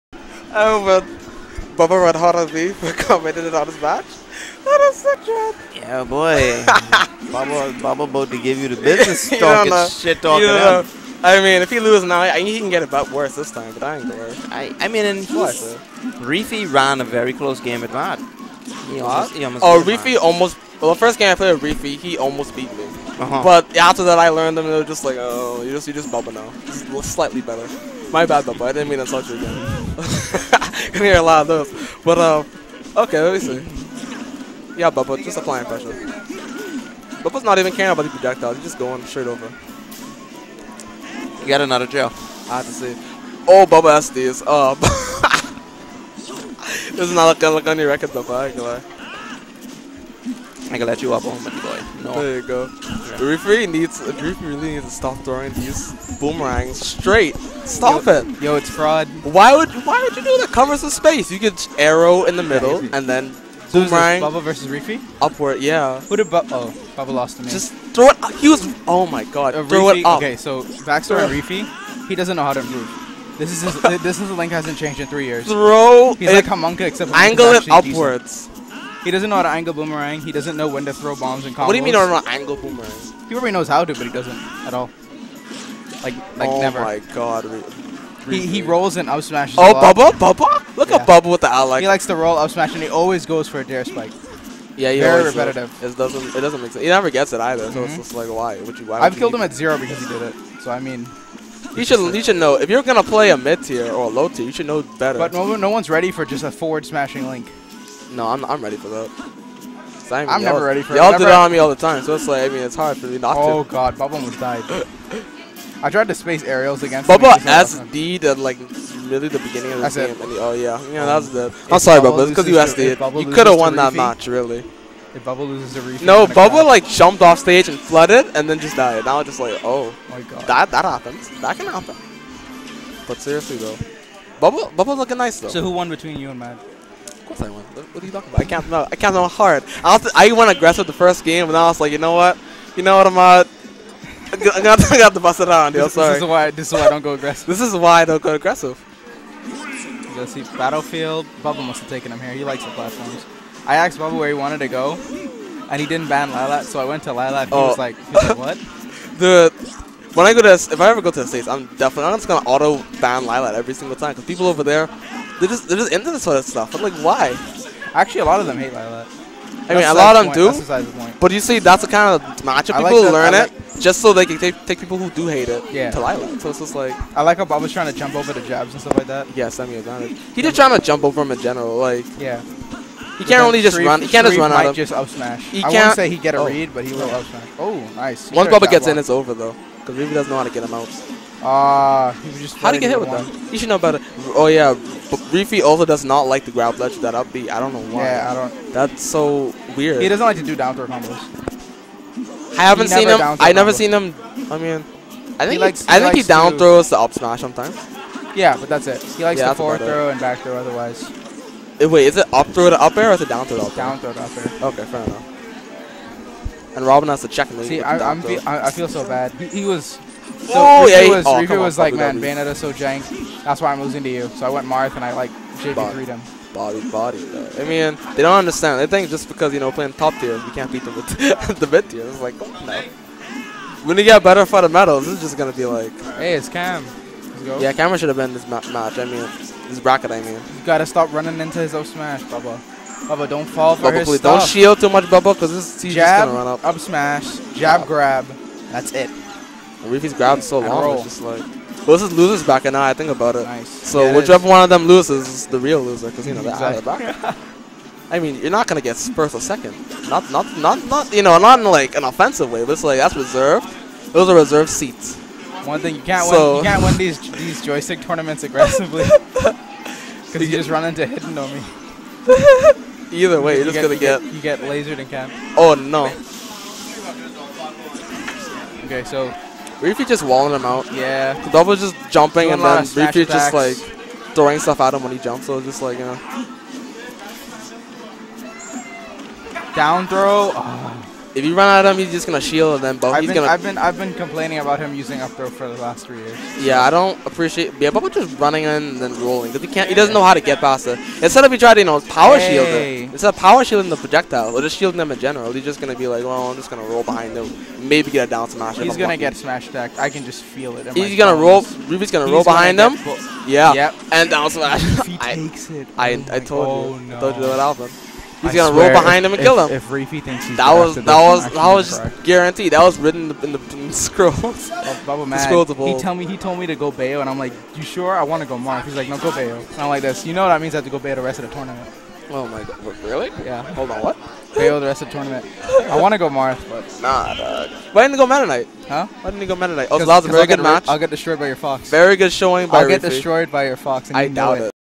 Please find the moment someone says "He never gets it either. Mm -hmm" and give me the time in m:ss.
1:36.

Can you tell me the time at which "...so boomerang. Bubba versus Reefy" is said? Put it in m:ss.
1:03.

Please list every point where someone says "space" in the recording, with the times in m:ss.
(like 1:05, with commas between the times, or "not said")
1:00, 1:56.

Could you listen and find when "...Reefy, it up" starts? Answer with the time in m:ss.
1:09.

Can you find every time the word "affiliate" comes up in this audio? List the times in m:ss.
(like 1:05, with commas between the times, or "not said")
not said.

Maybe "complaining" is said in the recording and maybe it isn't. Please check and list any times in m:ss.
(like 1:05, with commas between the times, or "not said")
4:54.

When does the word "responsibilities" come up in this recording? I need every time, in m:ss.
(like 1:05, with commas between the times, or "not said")
not said.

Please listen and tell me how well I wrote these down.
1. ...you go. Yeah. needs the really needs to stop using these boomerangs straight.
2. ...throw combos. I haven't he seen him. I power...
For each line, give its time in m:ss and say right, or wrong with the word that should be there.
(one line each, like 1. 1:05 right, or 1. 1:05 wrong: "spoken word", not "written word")
1. 0:52 wrong: "throwing", not "using"
2. 3:20 wrong: "never", not "power".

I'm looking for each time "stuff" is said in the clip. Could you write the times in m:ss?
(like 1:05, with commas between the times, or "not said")
2:46, 2:58, 4:04, 4:44.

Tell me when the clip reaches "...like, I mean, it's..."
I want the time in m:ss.
1:52.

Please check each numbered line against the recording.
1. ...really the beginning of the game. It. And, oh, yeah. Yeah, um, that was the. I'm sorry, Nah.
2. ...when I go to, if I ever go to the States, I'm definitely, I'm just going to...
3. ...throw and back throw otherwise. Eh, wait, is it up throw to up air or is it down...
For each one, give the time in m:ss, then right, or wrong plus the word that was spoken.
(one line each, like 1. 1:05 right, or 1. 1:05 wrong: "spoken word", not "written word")
1. 1:59 wrong: "Bubba", not "Nah"
2. 2:40 right
3. 3:29 right.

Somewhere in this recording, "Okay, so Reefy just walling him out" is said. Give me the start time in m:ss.
4:38.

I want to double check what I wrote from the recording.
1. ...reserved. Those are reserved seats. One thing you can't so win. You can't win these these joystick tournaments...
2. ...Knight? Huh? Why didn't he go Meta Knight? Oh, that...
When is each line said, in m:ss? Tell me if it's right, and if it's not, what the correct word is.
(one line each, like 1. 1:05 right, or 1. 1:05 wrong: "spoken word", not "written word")
1. 4:23 right
2. 5:38 right.